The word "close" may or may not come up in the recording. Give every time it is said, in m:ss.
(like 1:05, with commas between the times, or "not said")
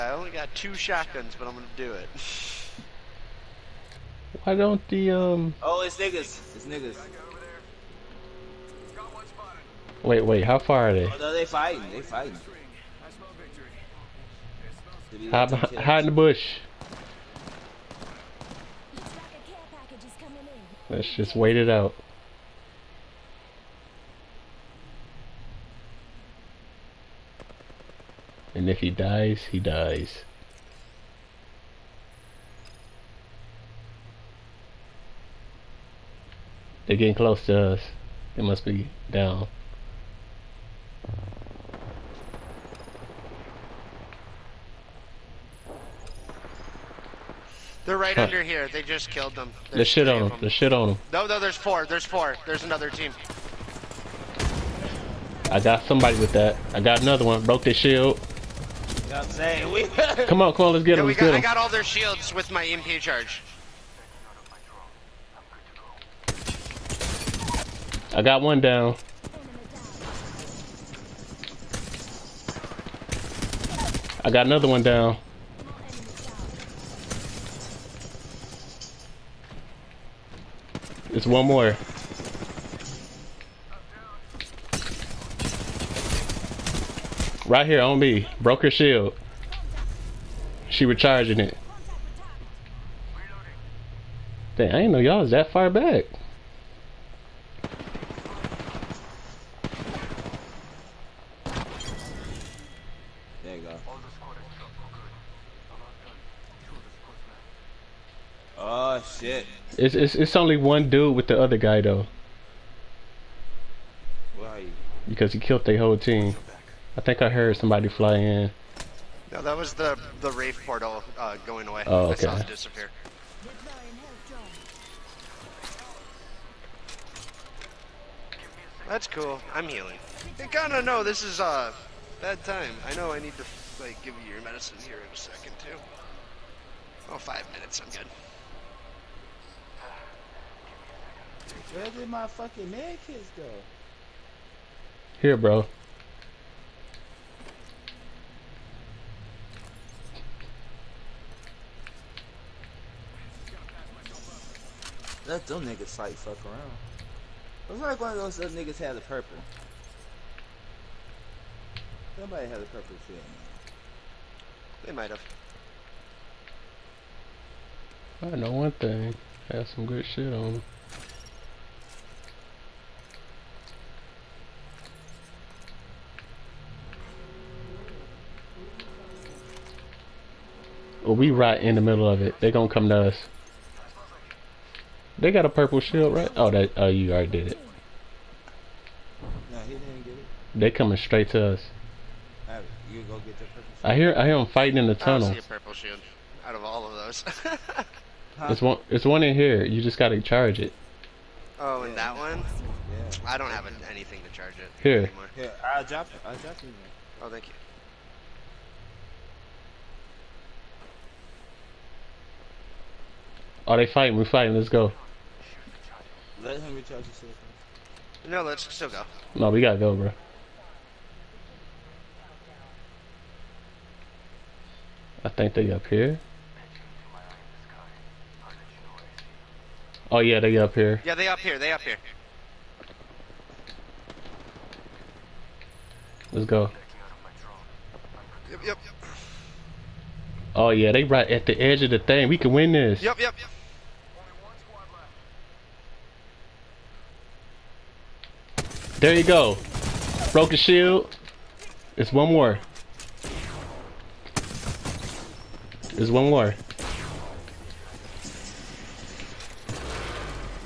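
0:37.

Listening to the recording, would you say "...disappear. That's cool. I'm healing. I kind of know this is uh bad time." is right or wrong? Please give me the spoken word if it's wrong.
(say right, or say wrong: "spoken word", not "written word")
right.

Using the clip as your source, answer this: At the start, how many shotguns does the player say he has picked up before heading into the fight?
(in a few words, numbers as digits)
2.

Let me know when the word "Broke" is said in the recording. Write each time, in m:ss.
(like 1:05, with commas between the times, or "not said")
0:57, 1:28, 4:10.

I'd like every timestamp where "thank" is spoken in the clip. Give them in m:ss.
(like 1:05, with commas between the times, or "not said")
3:27.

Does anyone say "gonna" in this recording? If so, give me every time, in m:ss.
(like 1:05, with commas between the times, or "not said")
0:01, 3:02.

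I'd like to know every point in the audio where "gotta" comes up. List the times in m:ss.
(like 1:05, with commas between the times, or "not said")
3:19, 3:39.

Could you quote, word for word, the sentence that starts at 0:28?
And if he dies, he dies.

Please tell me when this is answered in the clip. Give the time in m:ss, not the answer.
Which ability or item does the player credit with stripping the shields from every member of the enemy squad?
1:02.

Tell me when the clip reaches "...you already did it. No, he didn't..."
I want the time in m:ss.
3:06.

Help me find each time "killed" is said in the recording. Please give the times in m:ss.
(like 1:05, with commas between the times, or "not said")
0:49, 1:55.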